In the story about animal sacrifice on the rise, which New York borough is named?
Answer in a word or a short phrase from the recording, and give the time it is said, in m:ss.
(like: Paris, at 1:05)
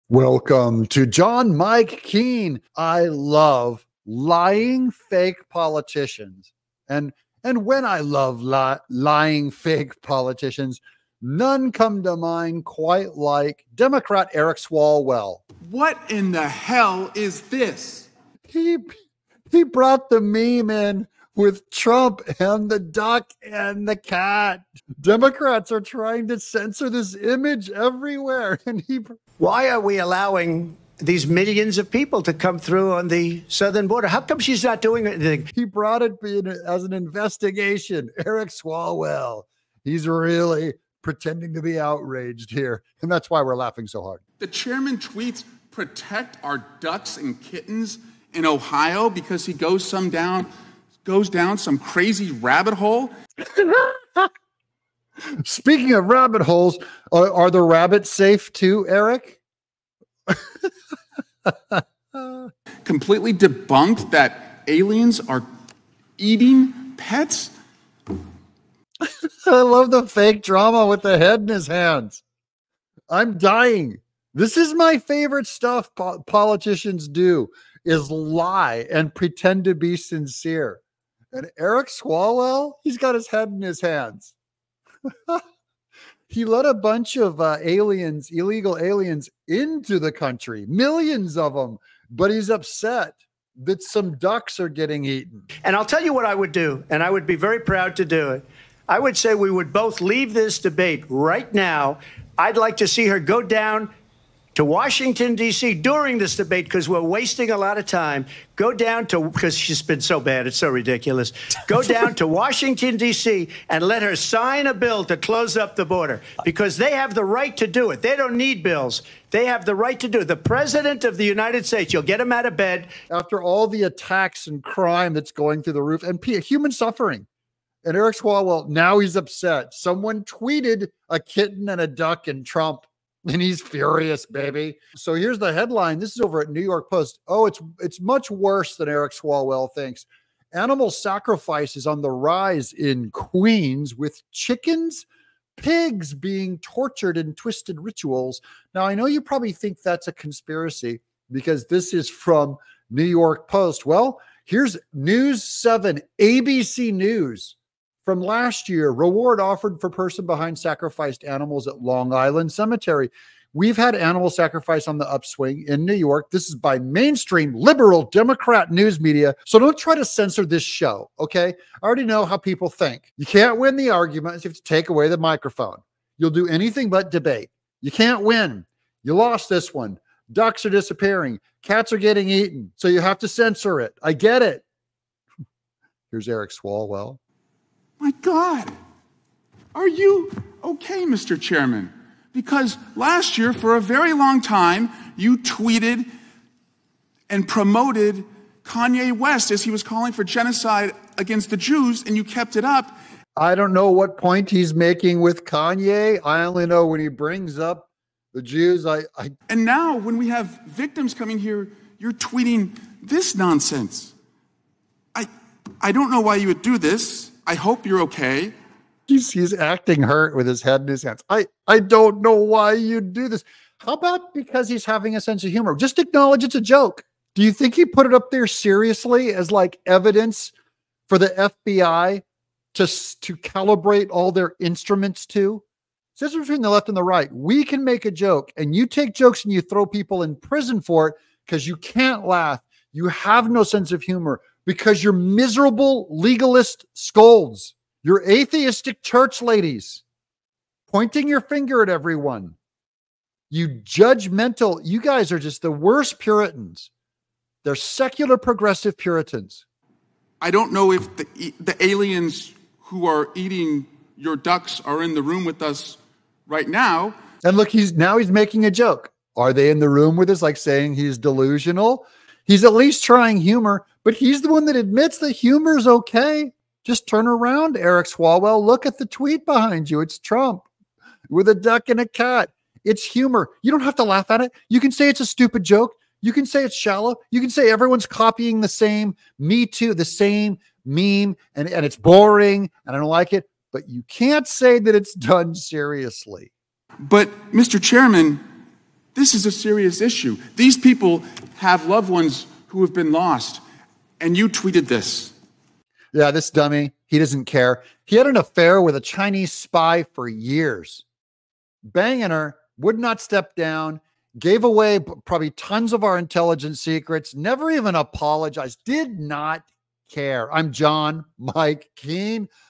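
Queens, at 2:23.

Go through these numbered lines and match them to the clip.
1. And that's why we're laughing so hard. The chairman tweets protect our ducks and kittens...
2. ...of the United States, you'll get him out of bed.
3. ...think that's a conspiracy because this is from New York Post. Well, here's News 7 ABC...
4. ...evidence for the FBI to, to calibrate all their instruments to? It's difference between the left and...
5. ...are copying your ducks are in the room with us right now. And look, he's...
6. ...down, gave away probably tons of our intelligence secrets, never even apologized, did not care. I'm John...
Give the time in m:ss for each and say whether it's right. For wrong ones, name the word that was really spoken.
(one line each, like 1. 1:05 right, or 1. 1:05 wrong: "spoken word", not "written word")
1. 0:43 right
2. 2:01 right
3. 2:29 right
4. 3:49 right
5. 4:23 wrong: "eating", not "copying"
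6. 5:13 right.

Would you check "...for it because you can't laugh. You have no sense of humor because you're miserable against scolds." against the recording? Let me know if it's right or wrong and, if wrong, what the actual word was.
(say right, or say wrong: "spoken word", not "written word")
wrong: "legalist", not "against".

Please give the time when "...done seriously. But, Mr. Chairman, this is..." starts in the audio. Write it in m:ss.
4:55.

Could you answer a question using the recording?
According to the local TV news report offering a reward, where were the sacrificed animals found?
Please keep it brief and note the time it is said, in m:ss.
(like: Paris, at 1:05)
Long Island Cemetery, at 2:41.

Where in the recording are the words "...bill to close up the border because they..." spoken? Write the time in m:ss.
1:54.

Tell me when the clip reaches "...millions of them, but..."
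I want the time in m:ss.
1:30.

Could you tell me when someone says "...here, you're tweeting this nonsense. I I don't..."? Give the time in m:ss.
3:31.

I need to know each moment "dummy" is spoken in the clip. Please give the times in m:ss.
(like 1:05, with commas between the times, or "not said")
5:06.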